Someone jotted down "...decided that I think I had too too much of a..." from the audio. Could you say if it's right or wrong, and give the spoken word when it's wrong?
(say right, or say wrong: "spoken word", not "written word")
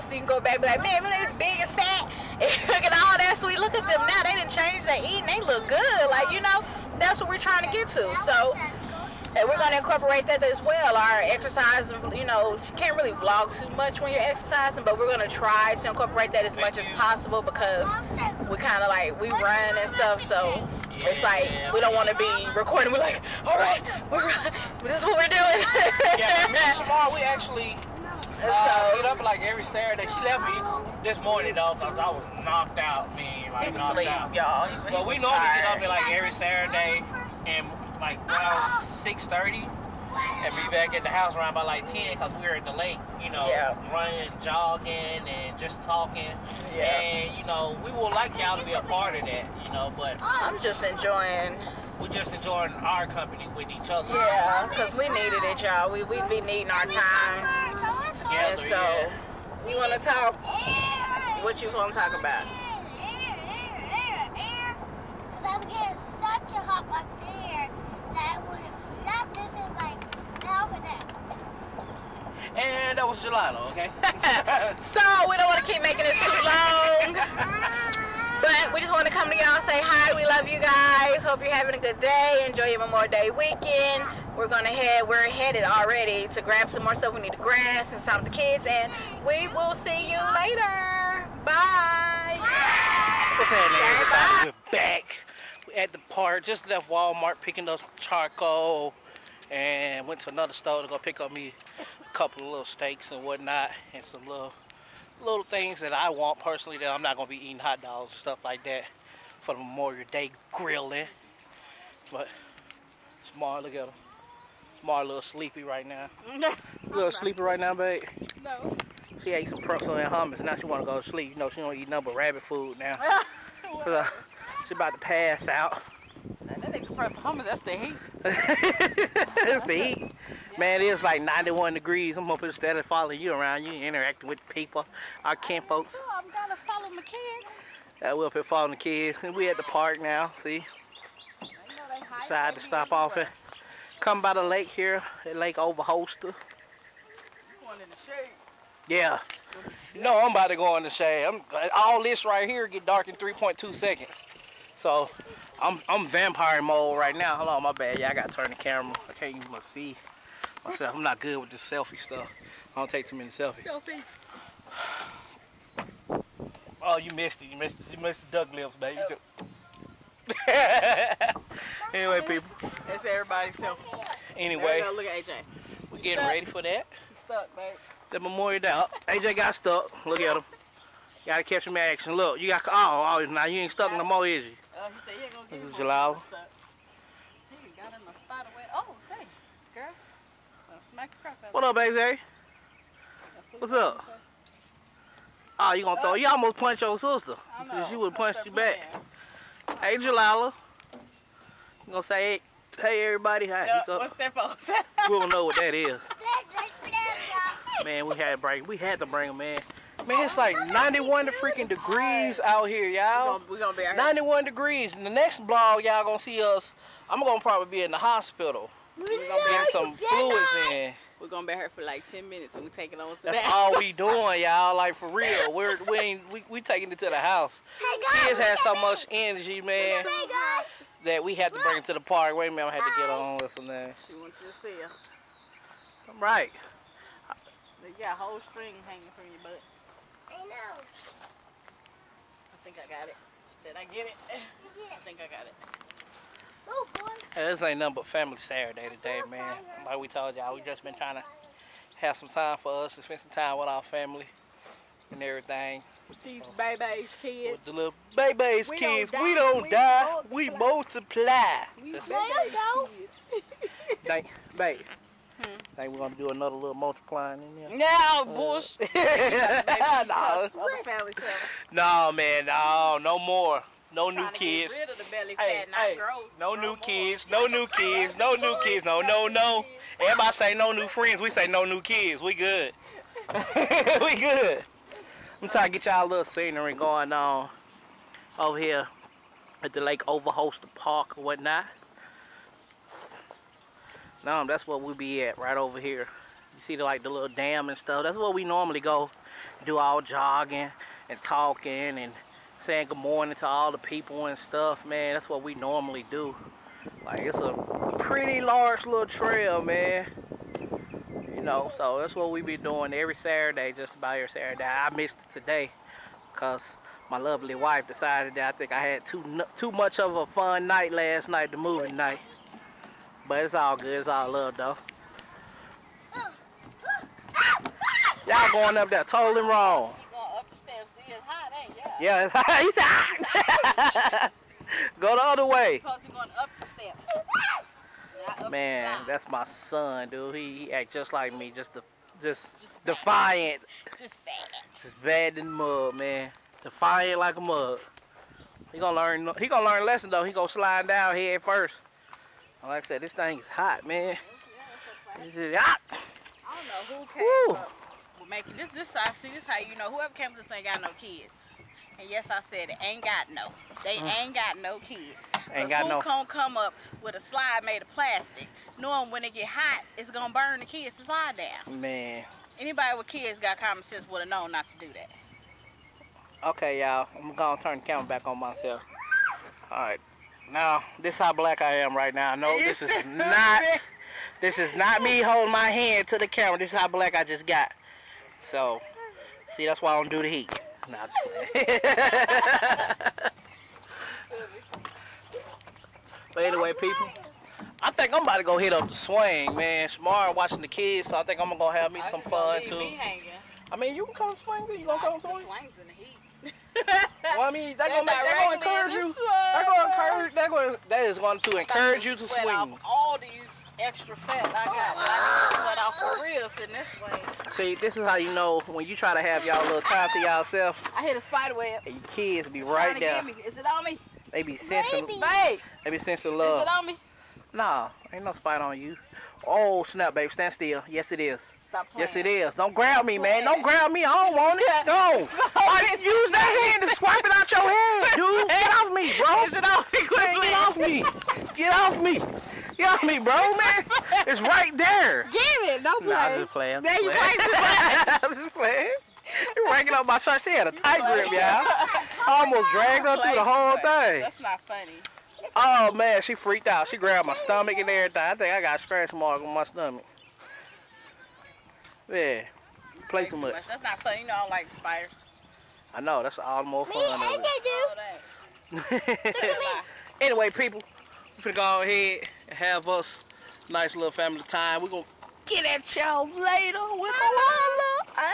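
right.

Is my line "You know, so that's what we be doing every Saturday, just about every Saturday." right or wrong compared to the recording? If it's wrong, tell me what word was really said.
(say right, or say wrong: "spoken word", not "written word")
right.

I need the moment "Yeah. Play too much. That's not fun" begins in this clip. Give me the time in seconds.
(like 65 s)
462 s.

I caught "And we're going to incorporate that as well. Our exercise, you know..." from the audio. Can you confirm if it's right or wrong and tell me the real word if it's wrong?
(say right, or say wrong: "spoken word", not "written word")
right.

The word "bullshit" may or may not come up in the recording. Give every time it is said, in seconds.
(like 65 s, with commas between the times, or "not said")
268 s.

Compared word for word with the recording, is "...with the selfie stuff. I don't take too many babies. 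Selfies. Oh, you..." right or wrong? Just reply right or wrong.
wrong.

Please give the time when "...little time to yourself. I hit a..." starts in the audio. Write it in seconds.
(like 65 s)
419 s.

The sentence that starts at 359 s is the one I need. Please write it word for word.
This how you know whoever came with this ain't got no kids.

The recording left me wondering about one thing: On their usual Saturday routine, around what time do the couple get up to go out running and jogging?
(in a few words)
6:30.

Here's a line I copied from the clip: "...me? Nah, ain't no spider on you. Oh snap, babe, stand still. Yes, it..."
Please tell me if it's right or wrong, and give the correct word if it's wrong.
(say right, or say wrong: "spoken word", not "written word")
right.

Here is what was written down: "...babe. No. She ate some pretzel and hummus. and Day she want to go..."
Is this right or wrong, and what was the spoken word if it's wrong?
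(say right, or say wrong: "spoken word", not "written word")
wrong: "Now", not "Day".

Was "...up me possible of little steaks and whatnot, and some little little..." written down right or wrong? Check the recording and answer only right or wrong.
wrong.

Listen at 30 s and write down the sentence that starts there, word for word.
She left me this morning though, cause I was knocked out, man, like knocked out.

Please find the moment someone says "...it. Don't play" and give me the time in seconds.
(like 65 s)
445 s.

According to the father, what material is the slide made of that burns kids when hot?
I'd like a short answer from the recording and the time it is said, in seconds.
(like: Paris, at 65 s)
Plastic, at 367 s.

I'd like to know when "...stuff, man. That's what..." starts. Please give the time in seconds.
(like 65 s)
304 s.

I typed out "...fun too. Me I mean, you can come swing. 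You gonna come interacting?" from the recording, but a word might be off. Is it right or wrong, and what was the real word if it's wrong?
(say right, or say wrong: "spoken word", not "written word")
wrong: "swing", not "interacting".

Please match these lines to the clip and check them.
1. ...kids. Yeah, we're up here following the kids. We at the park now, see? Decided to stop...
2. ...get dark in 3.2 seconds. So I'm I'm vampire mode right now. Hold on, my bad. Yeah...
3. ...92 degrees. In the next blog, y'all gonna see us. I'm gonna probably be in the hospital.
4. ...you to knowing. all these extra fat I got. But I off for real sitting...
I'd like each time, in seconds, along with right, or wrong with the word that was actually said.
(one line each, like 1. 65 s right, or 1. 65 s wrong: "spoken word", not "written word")
1. 137 s right
2. 152 s right
3. 213 s wrong: "91", not "92"
4. 412 s wrong: "swing", not "knowing".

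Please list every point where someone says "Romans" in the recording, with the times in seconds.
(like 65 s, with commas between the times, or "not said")
not said.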